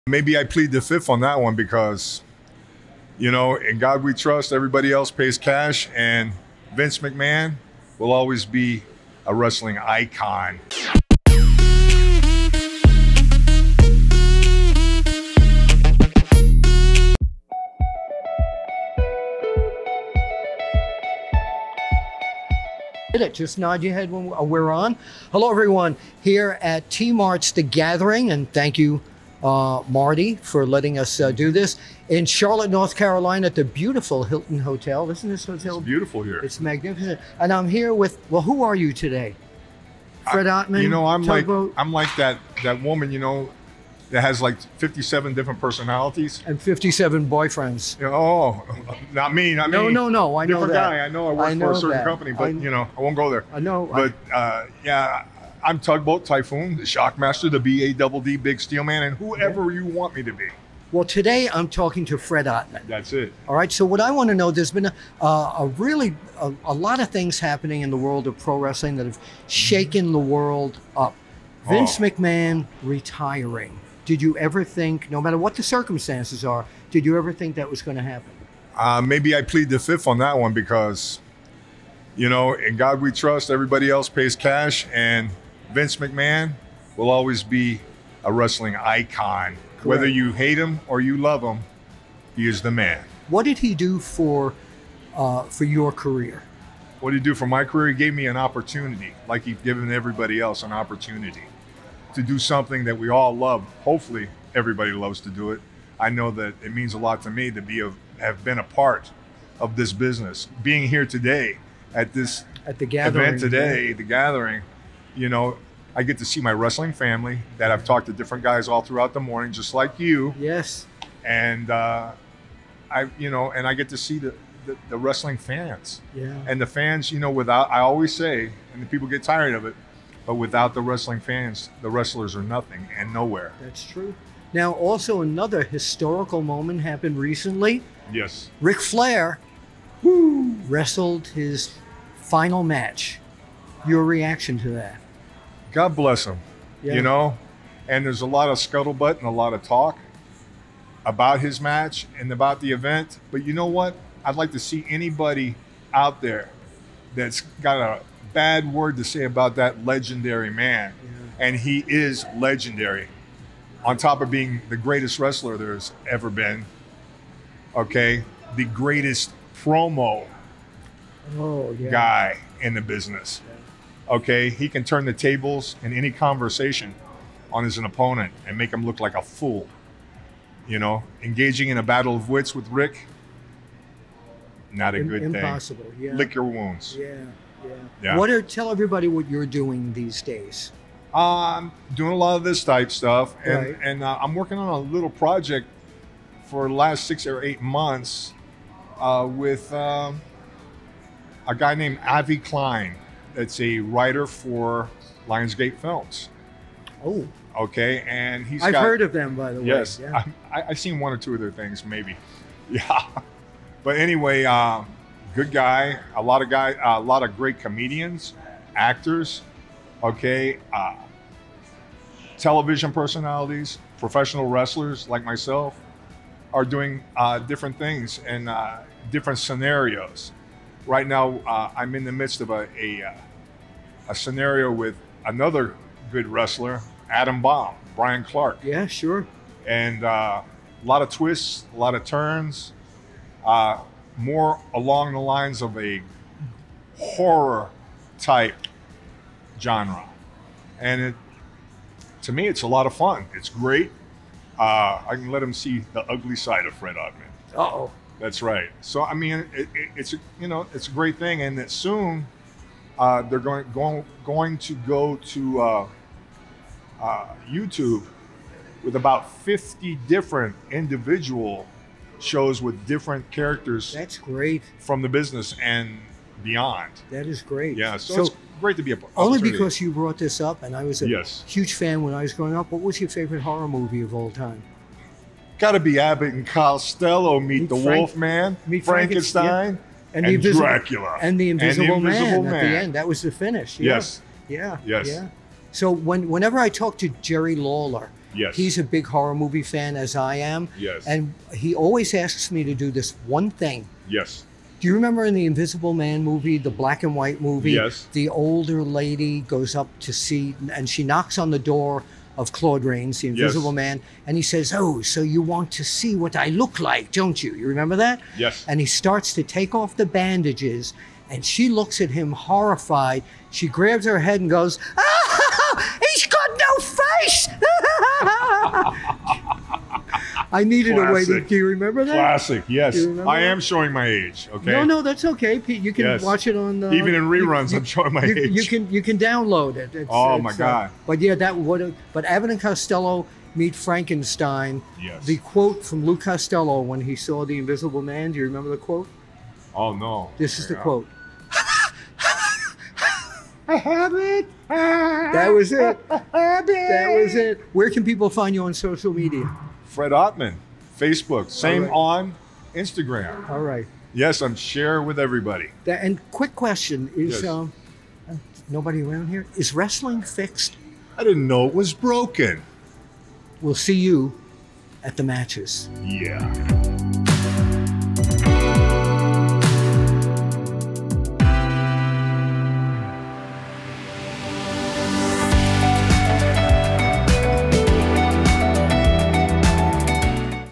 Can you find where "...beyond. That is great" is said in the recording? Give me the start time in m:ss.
4:36.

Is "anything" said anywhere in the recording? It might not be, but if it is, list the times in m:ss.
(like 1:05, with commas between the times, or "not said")
not said.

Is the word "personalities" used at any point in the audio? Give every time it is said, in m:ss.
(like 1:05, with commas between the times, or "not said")
0:45, 3:42.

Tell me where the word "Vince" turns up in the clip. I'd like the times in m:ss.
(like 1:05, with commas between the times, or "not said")
0:06, 1:11, 1:25.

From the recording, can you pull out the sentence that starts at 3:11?
I'm um, doing a lot of this type stuff, and right.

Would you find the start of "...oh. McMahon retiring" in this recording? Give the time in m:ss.
1:11.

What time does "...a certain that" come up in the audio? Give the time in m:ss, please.
0:51.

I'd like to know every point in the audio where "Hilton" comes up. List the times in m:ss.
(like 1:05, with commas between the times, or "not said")
0:34.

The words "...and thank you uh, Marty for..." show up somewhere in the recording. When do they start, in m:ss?
0:28.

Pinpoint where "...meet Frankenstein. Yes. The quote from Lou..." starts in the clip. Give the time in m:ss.
5:43.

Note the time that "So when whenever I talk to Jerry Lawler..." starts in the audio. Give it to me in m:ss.
4:55.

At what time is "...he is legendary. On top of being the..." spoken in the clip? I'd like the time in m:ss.
2:41.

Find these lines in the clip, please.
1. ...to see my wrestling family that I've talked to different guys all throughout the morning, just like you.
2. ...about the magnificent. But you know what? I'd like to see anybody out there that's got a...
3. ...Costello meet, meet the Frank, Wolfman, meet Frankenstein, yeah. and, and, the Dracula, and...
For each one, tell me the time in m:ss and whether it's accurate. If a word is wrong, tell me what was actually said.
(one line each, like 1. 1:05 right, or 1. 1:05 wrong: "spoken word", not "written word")
1. 1:56 right
2. 2:32 wrong: "event", not "magnificent"
3. 4:46 right.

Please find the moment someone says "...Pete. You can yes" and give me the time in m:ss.
5:35.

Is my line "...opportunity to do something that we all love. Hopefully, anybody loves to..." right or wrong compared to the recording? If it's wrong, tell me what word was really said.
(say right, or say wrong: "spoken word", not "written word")
wrong: "everybody", not "anybody".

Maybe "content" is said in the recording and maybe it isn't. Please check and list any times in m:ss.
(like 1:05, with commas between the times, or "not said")
not said.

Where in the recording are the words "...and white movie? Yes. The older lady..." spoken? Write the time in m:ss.
5:07.